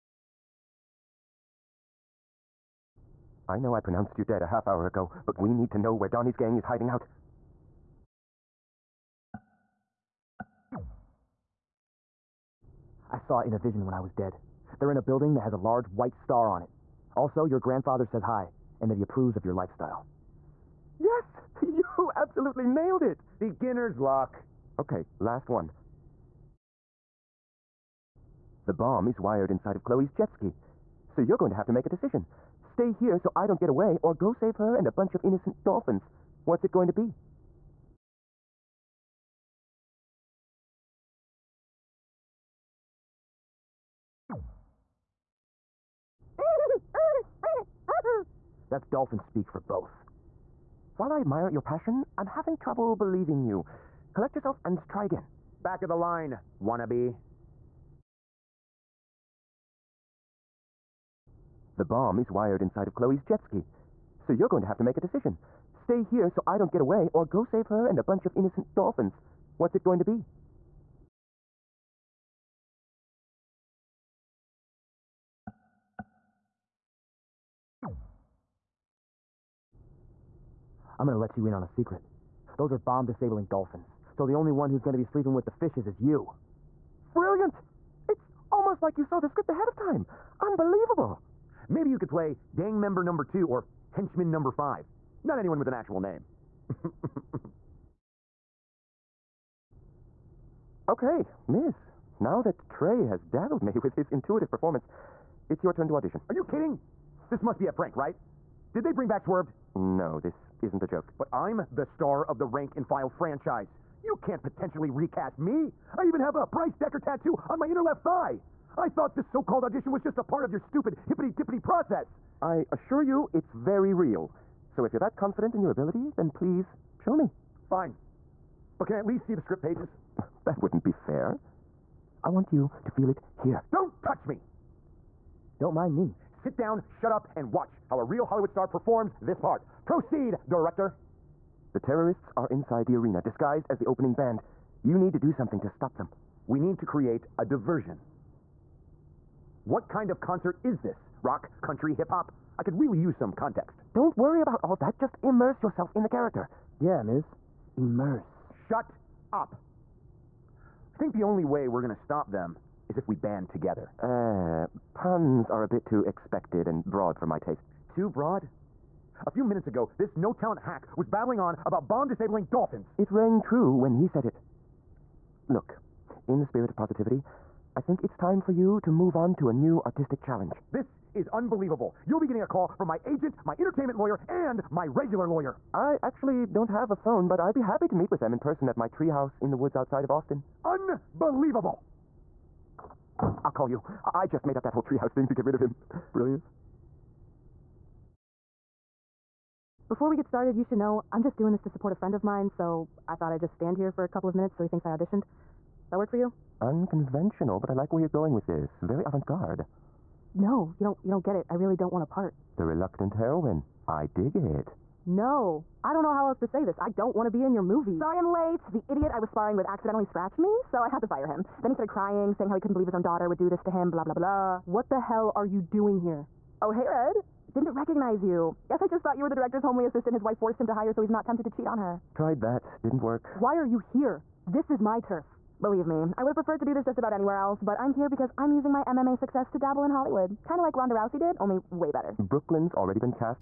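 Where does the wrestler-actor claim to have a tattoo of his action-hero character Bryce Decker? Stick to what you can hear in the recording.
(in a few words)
inner left thigh.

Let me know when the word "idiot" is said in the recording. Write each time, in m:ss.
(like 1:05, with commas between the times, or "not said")
3:38.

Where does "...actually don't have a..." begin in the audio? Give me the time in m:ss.
3:06.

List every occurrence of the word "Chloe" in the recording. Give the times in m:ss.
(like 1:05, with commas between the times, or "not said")
0:29, 1:02.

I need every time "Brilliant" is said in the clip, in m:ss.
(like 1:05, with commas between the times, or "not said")
1:27, 3:16.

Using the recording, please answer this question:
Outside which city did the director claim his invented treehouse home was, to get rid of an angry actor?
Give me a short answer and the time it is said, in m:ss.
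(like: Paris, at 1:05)
Austin, at 3:10.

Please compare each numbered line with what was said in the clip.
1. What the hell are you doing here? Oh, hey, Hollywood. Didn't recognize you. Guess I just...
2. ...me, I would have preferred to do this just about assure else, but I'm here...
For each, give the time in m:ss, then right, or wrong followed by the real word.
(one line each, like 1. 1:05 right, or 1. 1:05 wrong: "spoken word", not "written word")
1. 3:44 wrong: "Red", not "Hollywood"
2. 3:55 wrong: "anywhere", not "assure".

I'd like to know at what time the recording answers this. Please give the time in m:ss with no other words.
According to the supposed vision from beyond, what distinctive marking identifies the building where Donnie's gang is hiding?
0:15.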